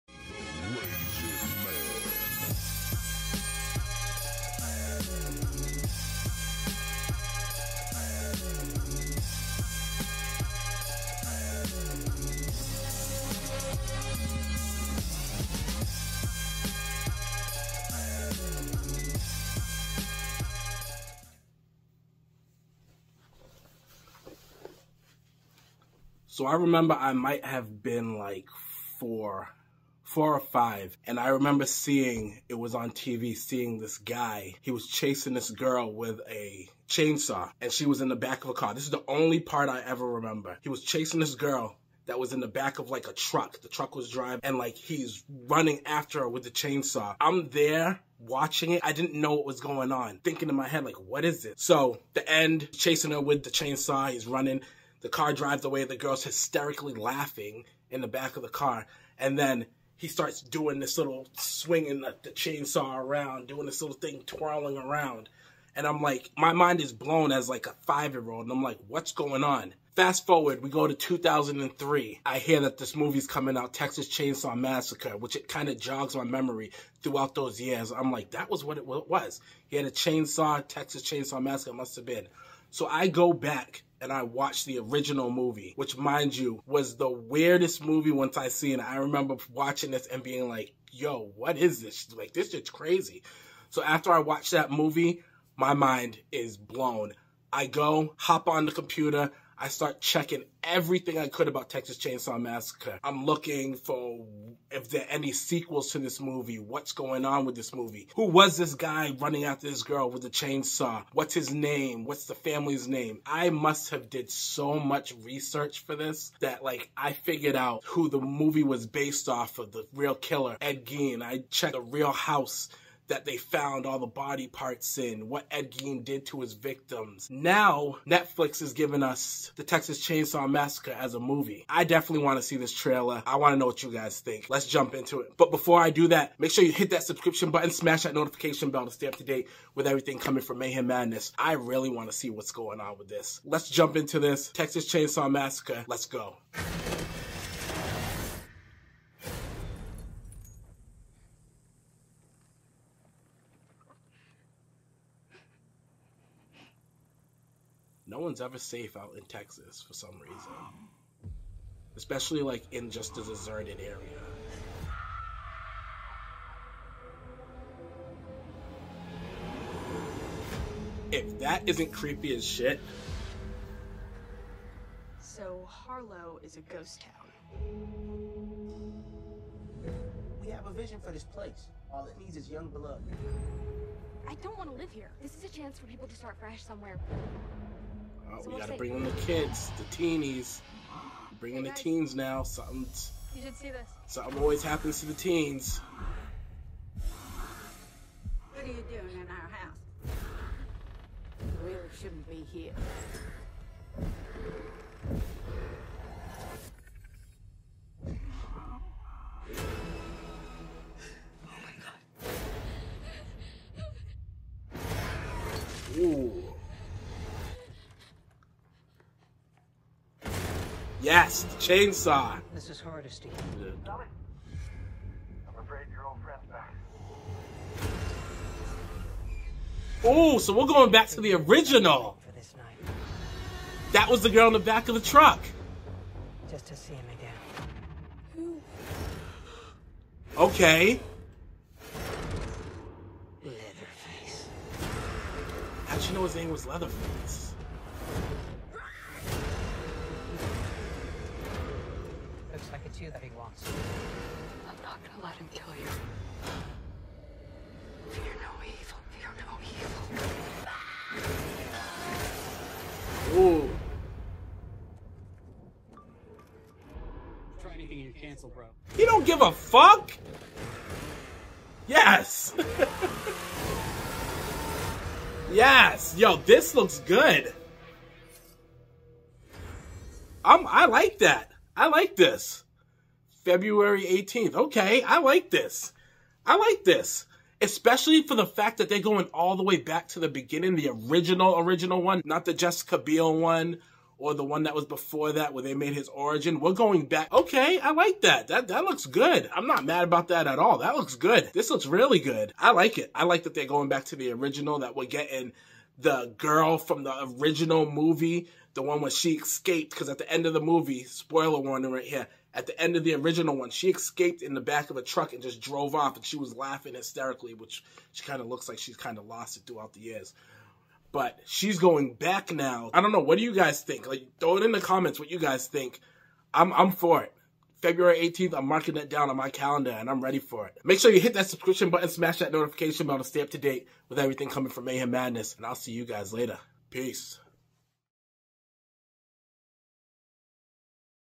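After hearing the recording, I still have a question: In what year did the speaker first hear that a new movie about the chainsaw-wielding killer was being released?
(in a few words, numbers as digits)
2003.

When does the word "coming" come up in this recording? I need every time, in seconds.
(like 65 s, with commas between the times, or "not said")
73 s, 140 s, 334 s.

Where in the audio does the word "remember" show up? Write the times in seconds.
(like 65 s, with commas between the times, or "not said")
26 s, 31 s, 40 s, 88 s.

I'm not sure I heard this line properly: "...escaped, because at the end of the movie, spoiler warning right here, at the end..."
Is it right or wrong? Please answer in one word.
right.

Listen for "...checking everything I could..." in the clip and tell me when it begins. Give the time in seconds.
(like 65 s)
100 s.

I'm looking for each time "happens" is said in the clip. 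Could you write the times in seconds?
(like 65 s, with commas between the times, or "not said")
194 s.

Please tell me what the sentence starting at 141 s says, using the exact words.
I really want to see what's going on with this.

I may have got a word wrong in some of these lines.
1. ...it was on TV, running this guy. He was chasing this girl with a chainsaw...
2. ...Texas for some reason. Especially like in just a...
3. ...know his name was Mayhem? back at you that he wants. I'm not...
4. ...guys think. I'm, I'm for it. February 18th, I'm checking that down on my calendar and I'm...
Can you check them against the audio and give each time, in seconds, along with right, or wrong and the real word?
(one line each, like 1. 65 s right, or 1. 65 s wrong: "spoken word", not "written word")
1. 32 s wrong: "seeing", not "running"
2. 159 s right
3. 246 s wrong: "Leatherface", not "Mayhem"
4. 325 s wrong: "marking", not "checking".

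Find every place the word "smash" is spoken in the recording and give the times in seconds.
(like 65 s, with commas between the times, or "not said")
137 s, 332 s.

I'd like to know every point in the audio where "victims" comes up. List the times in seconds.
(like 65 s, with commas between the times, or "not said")
126 s.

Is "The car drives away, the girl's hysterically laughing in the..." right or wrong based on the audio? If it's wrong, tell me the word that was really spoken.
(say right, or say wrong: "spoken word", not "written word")
right.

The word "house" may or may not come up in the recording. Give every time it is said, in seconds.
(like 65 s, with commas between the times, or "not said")
122 s, 199 s.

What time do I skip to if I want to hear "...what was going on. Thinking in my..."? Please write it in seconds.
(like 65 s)
49 s.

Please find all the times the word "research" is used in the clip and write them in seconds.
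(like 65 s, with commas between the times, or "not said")
115 s.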